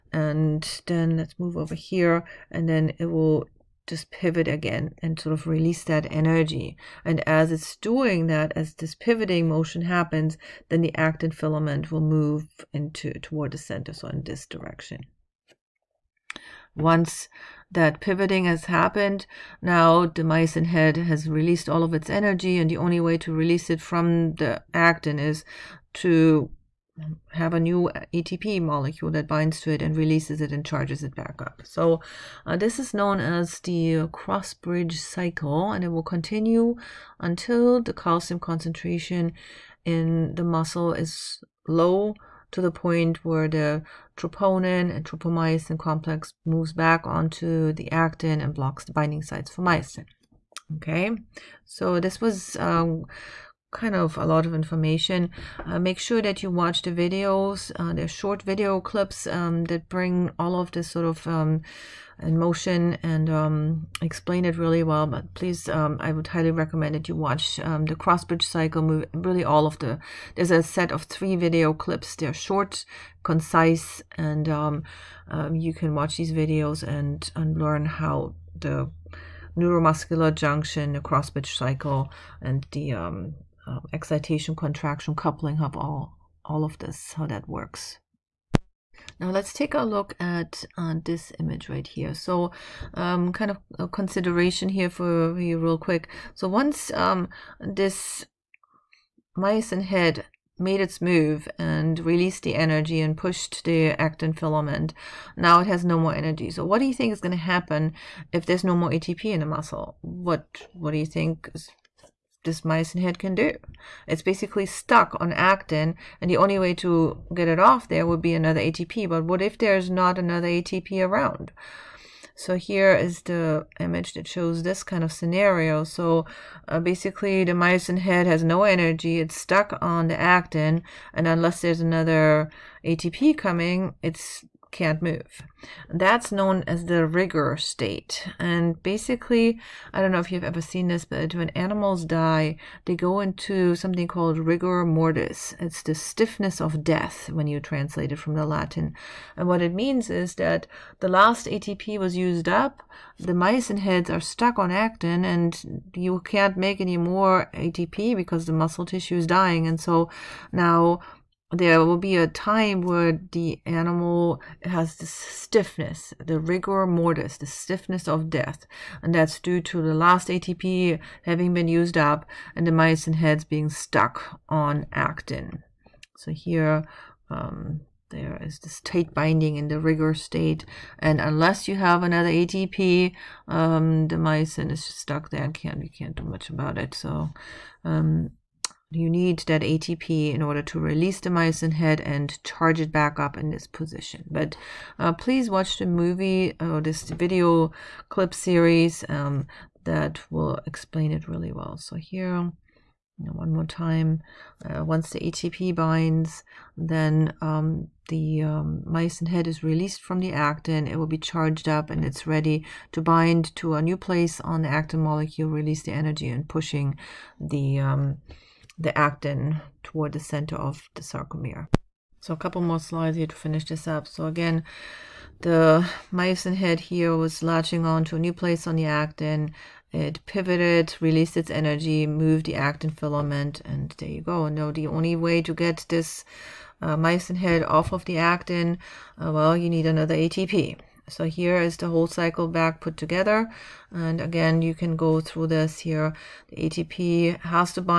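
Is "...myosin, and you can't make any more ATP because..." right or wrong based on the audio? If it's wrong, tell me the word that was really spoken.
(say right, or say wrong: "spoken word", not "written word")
wrong: "actin", not "myosin".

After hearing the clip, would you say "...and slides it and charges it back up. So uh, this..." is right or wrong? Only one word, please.
wrong.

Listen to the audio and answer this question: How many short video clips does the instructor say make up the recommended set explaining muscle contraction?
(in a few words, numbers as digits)
3.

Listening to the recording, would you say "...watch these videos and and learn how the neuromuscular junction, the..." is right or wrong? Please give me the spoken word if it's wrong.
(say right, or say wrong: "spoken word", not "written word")
right.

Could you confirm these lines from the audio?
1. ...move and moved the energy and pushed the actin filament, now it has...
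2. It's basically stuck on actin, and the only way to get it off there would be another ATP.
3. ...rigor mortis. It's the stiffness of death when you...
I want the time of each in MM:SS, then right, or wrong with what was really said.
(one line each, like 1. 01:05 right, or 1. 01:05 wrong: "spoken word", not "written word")
1. 01:40 wrong: "released", not "moved"
2. 01:54 right
3. 02:24 right.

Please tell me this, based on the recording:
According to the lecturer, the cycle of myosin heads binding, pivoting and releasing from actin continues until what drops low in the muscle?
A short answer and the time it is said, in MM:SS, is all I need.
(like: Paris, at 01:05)
calcium concentration, at 00:37.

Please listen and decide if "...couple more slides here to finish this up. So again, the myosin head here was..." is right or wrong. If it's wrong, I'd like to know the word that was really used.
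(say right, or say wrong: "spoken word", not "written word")
right.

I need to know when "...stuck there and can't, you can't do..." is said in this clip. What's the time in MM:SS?
03:04.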